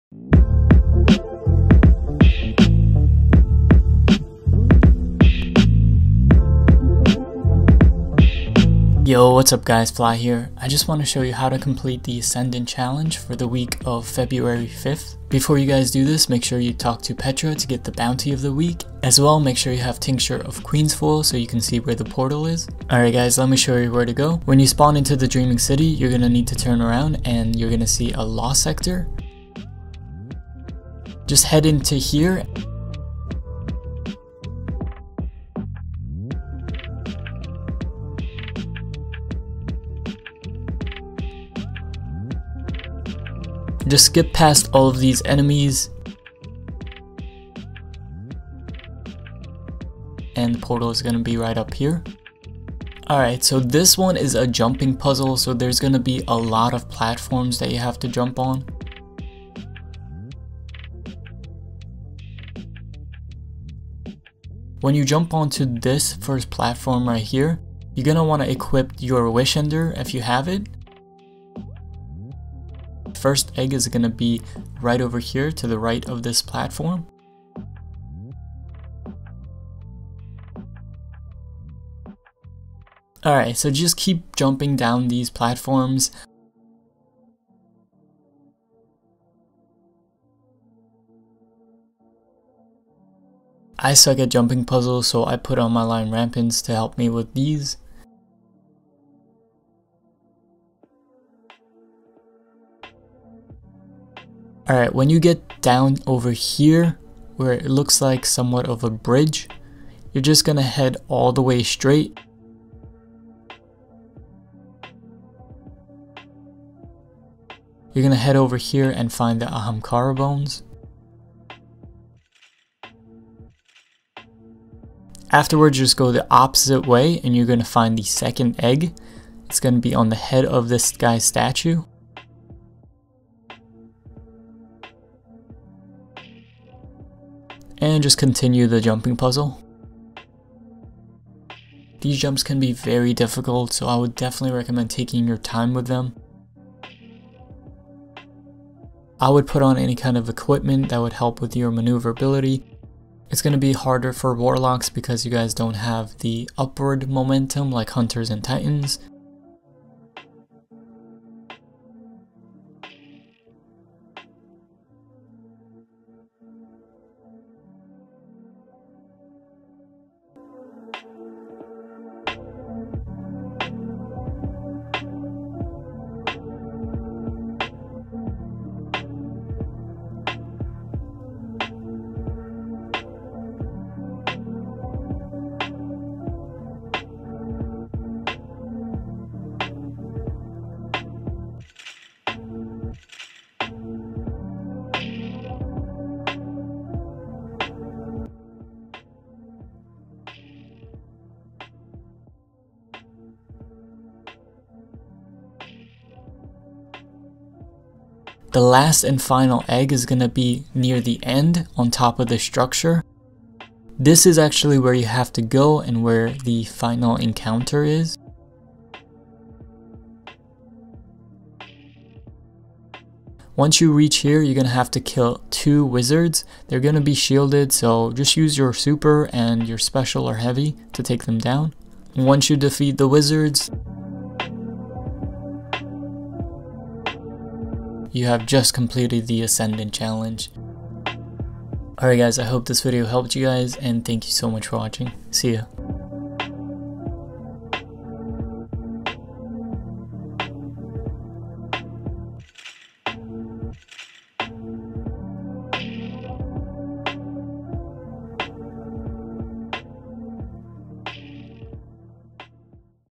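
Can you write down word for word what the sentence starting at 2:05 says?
Afterwards, just go the opposite way and you're gonna find the second egg.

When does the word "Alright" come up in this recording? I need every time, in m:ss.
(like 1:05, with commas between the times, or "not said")
0:22, 0:53, 1:23, 1:44, 4:02.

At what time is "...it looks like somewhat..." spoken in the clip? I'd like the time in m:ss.
1:47.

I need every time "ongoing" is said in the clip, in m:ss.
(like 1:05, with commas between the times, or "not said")
not said.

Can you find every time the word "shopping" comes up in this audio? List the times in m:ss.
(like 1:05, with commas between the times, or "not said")
not said.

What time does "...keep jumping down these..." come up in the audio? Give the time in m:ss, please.
1:23.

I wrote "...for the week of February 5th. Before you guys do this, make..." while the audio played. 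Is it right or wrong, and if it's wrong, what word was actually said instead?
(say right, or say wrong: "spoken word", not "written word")
right.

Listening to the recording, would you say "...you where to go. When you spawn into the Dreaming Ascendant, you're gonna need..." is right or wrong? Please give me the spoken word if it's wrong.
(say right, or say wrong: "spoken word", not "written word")
wrong: "City", not "Ascendant".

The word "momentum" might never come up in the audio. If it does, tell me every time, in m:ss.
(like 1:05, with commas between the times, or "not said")
2:37.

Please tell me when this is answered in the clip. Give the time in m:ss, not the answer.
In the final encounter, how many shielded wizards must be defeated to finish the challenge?
3:45.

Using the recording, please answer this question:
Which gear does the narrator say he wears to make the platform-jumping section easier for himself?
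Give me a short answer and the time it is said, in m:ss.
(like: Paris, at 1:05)
Lion Rampants, at 1:35.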